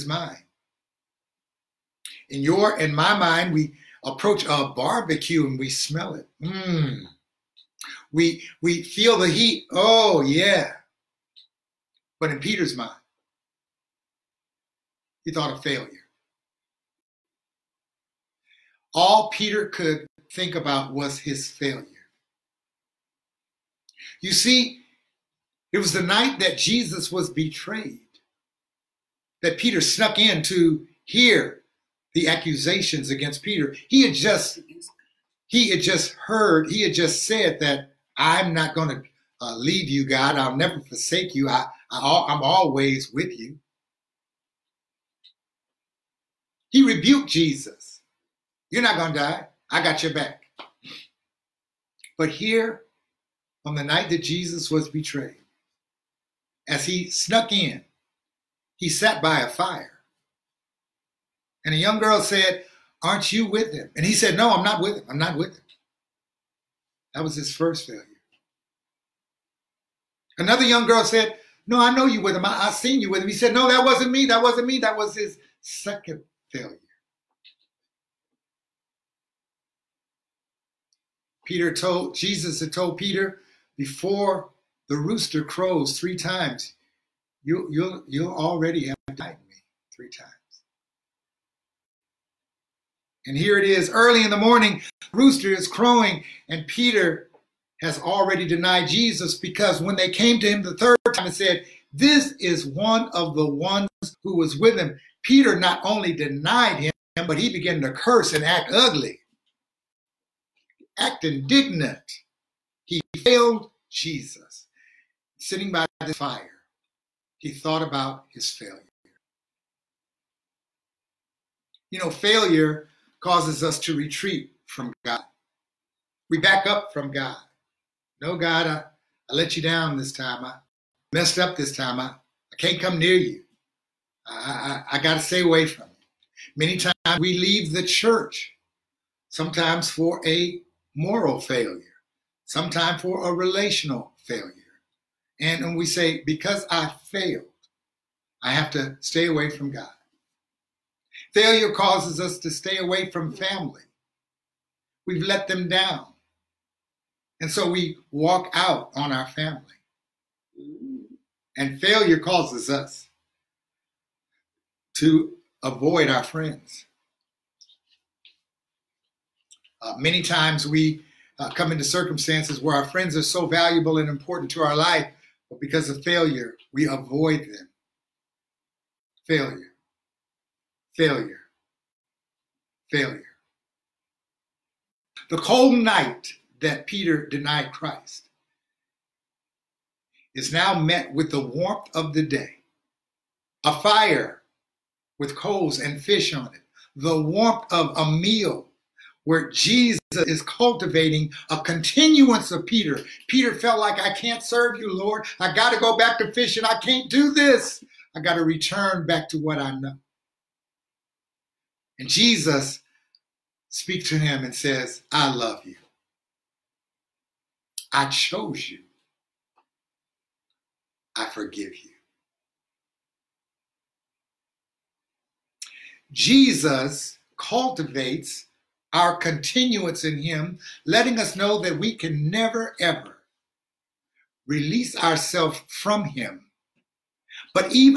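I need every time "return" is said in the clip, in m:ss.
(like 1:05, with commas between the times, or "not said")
3:28.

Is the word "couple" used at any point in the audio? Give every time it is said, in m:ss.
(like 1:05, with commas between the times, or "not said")
not said.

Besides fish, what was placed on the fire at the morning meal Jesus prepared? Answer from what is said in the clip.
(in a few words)
Coals.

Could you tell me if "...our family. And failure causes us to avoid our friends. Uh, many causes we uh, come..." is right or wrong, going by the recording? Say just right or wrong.
wrong.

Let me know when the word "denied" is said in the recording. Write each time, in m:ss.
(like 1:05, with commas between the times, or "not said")
1:29, 1:38, 1:46, 3:07.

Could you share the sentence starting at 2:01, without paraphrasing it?
You know, failure causes us to retreat from God.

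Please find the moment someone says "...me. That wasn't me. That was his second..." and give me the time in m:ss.
1:14.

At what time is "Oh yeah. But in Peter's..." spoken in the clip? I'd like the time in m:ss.
0:09.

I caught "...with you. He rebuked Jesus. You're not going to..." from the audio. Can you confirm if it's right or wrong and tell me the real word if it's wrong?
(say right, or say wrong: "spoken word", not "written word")
right.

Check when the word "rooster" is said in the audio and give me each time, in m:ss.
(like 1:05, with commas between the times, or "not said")
1:24, 1:35.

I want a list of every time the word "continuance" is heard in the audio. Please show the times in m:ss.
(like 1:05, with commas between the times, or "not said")
3:21, 3:49.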